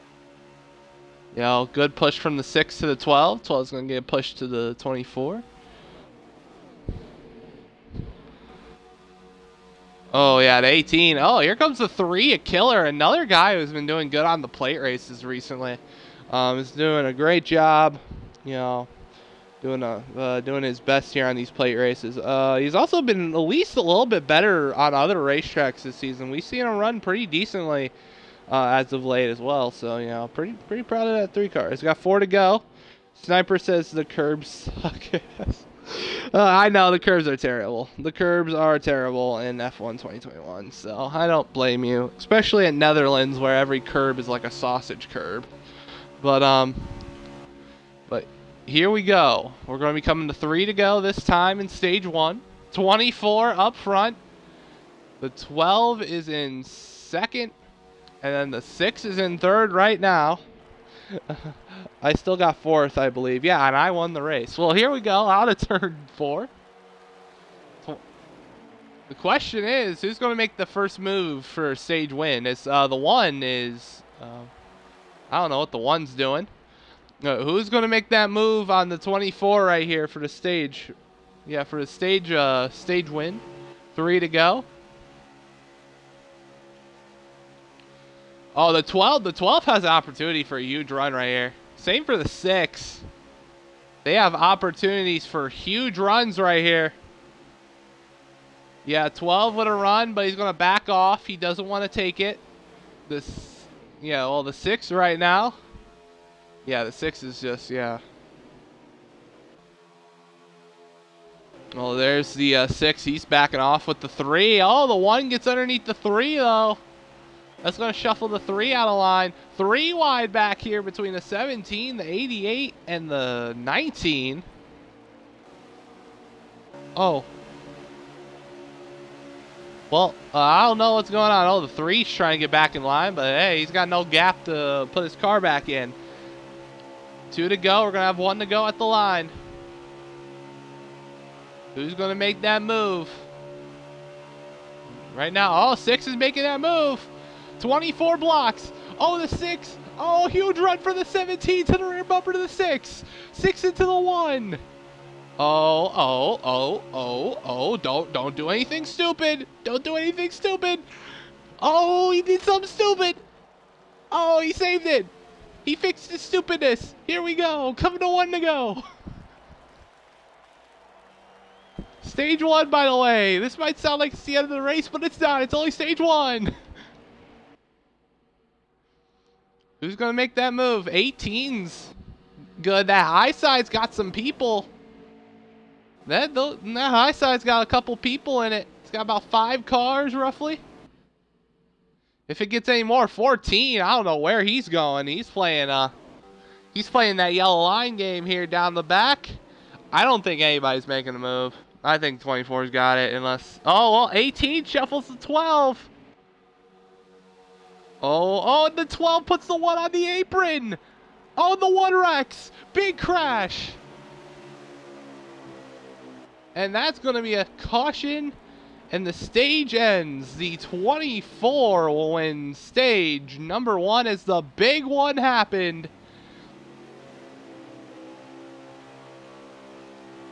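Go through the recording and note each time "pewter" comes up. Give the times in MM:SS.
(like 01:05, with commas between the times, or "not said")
not said.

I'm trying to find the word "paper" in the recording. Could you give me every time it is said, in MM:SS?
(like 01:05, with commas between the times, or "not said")
not said.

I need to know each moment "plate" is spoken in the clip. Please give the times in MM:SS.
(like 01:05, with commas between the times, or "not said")
00:14, 00:21.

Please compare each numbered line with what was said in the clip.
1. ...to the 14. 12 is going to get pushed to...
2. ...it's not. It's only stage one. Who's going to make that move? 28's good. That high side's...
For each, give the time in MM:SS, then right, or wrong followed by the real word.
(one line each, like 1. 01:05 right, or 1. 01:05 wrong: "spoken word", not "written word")
1. 00:02 wrong: "12", not "14"
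2. 02:55 wrong: "18", not "28".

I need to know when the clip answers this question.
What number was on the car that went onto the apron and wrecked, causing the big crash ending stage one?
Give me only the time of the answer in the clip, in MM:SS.
03:31.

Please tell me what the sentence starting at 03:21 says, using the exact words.
I think 24's got it unless, oh, well, 18 shuffles to 12.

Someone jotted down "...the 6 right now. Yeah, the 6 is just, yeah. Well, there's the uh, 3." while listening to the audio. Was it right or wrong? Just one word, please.
wrong.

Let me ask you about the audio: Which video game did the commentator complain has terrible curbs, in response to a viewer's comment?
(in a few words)
F1 2021.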